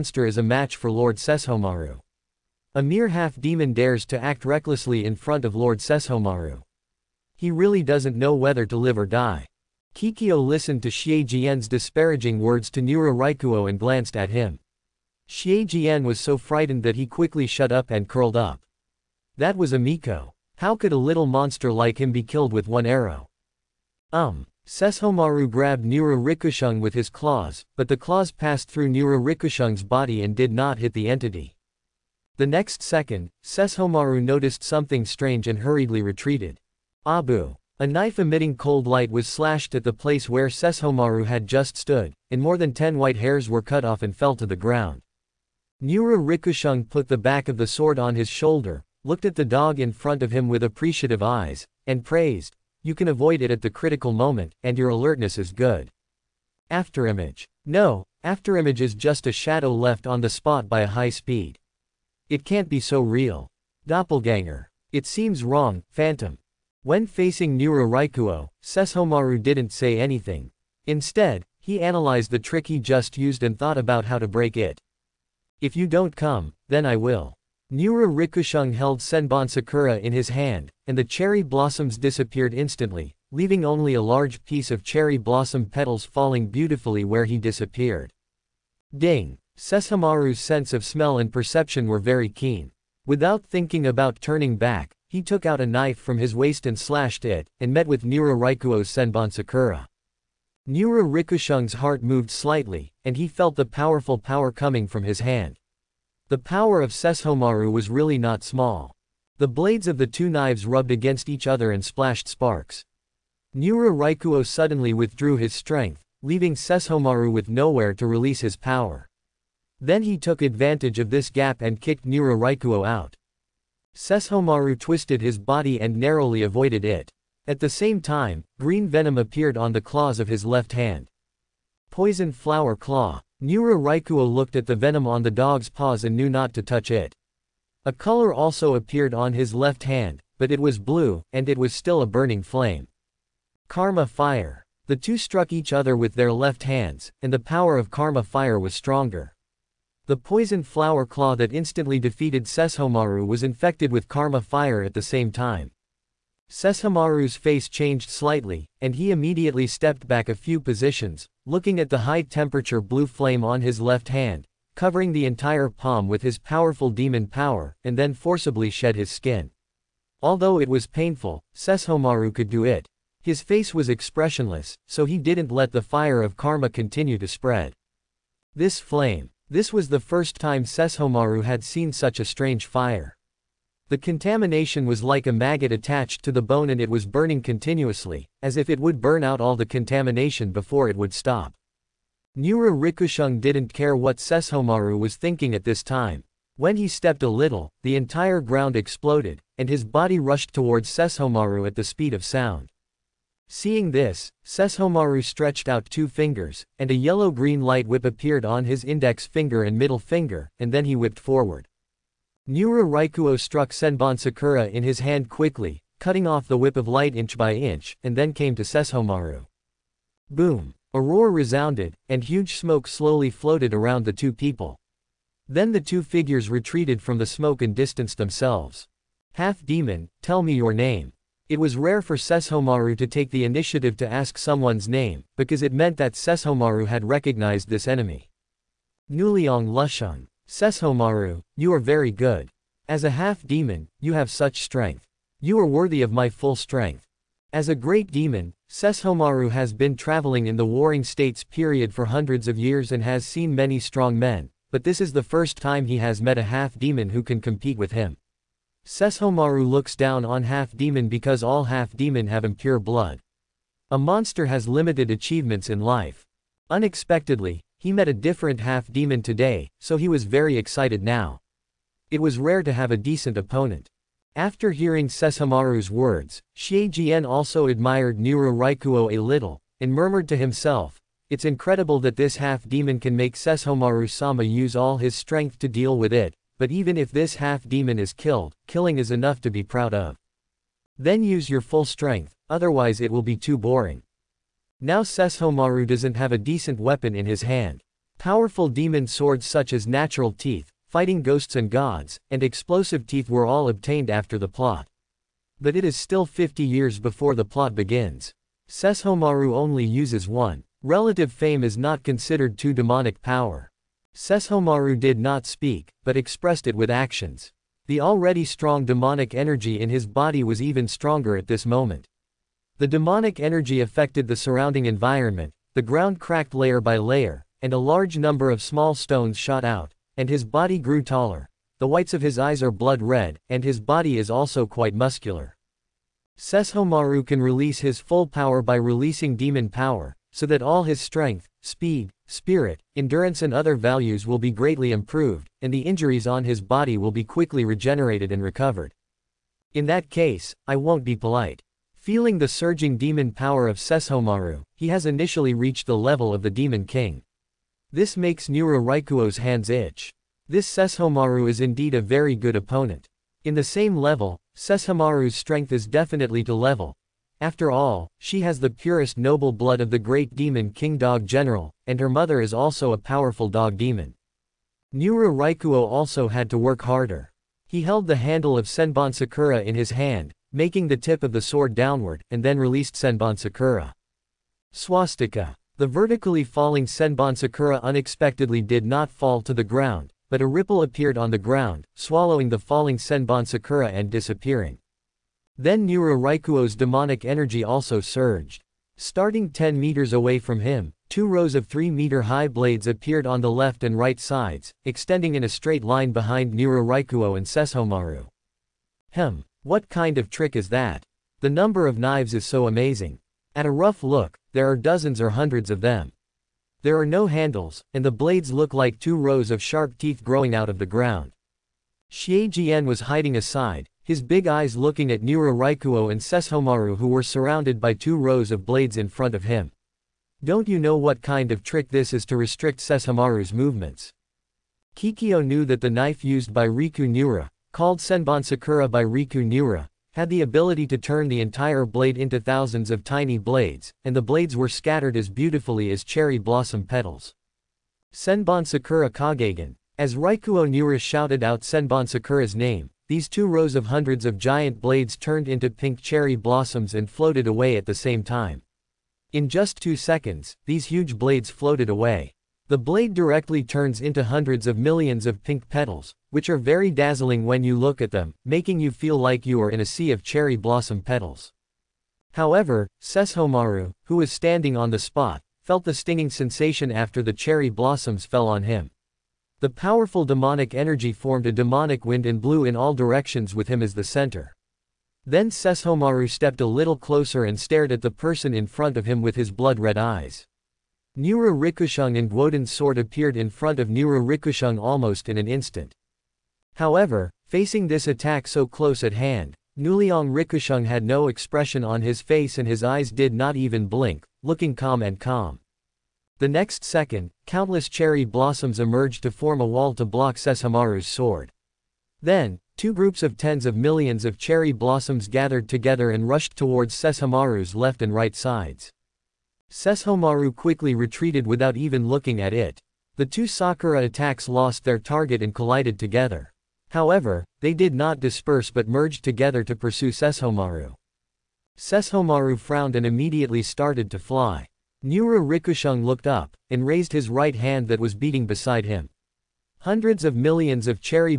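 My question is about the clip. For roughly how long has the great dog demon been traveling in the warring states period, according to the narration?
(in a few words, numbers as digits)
Hundreds of years.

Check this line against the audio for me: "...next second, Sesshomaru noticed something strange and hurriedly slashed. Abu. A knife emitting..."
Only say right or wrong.
wrong.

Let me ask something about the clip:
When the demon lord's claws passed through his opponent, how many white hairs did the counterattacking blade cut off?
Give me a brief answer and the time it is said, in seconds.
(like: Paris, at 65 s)
more than 10, at 42 s.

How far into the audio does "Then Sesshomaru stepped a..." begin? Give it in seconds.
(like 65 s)
485 s.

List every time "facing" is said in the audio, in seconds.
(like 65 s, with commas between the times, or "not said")
67 s, 497 s.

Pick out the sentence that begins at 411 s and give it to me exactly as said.
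The number of knives is so amazing.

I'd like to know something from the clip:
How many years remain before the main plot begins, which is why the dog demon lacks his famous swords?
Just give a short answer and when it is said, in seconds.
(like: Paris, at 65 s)
50, at 306 s.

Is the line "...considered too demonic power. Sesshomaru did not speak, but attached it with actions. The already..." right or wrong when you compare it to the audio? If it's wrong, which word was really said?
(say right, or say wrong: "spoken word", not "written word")
wrong: "expressed", not "attached".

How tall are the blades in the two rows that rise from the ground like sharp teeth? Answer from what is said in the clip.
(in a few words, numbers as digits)
3 meters.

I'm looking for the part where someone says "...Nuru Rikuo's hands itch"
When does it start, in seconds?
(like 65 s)
358 s.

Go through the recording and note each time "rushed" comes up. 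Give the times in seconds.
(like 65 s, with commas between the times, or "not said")
200 s, 516 s.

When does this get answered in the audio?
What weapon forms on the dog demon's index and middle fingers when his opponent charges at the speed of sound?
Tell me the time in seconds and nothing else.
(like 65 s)
207 s.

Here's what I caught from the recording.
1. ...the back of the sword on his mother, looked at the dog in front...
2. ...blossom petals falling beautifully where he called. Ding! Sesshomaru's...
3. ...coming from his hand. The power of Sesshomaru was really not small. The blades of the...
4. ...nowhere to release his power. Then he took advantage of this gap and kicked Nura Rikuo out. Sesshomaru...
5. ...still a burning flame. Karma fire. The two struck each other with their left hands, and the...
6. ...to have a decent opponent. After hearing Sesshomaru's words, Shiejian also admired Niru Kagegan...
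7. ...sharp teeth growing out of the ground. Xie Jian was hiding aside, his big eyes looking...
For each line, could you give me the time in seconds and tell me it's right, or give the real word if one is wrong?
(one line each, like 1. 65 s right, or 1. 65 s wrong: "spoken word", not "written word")
1. 47 s wrong: "shoulder", not "mother"
2. 85 s wrong: "disappeared", not "called"
3. 104 s right
4. 117 s right
5. 141 s right
6. 272 s wrong: "Rikuo", not "Kagegan"
7. 419 s right.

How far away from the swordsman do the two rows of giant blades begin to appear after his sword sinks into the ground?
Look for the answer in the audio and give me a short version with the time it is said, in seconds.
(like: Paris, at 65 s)
10 meters, at 399 s.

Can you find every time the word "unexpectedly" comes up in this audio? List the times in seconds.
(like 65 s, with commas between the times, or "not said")
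266 s, 387 s.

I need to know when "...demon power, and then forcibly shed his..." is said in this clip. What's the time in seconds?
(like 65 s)
166 s.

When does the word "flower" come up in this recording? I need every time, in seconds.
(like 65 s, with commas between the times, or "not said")
132 s, 150 s.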